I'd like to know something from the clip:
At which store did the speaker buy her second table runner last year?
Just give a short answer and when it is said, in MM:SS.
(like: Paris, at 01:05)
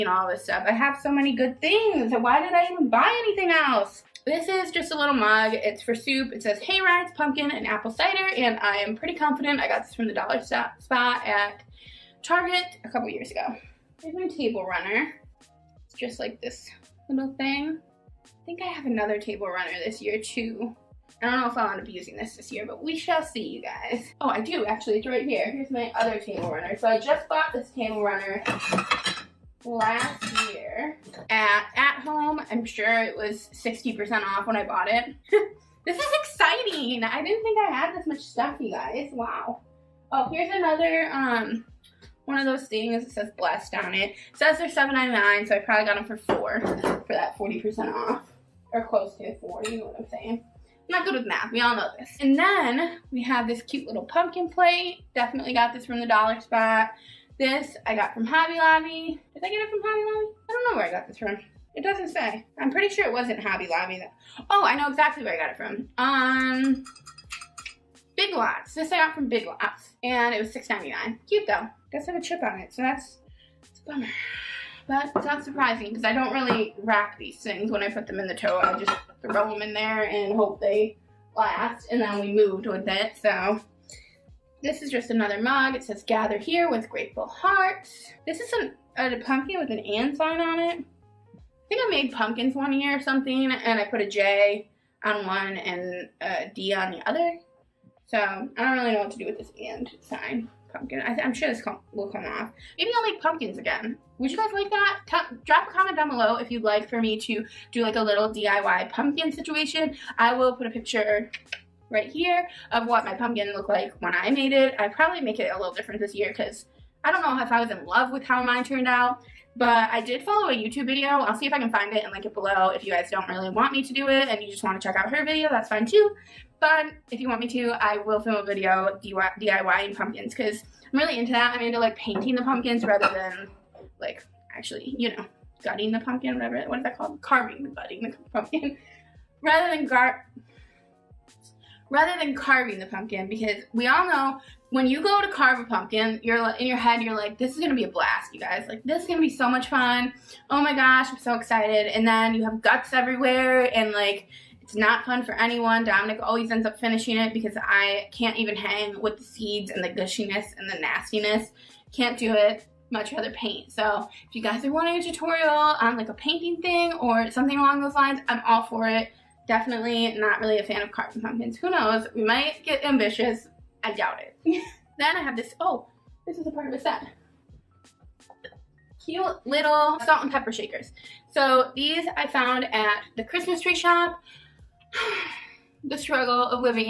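At Home, at 00:31.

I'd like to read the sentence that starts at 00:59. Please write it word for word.
Did I get it from Hobby Lobby?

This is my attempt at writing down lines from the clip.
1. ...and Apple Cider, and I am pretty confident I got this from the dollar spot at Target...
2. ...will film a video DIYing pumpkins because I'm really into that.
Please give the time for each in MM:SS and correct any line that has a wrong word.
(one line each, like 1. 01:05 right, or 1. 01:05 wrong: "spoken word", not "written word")
1. 00:07 right
2. 02:07 right.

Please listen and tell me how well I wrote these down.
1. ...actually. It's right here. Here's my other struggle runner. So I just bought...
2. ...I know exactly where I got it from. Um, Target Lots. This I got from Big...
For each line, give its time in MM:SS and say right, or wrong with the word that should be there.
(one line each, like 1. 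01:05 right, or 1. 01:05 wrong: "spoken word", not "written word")
1. 00:24 wrong: "table", not "struggle"
2. 01:04 wrong: "Big", not "Target".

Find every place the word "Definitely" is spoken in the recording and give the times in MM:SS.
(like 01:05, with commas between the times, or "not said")
00:55, 02:49.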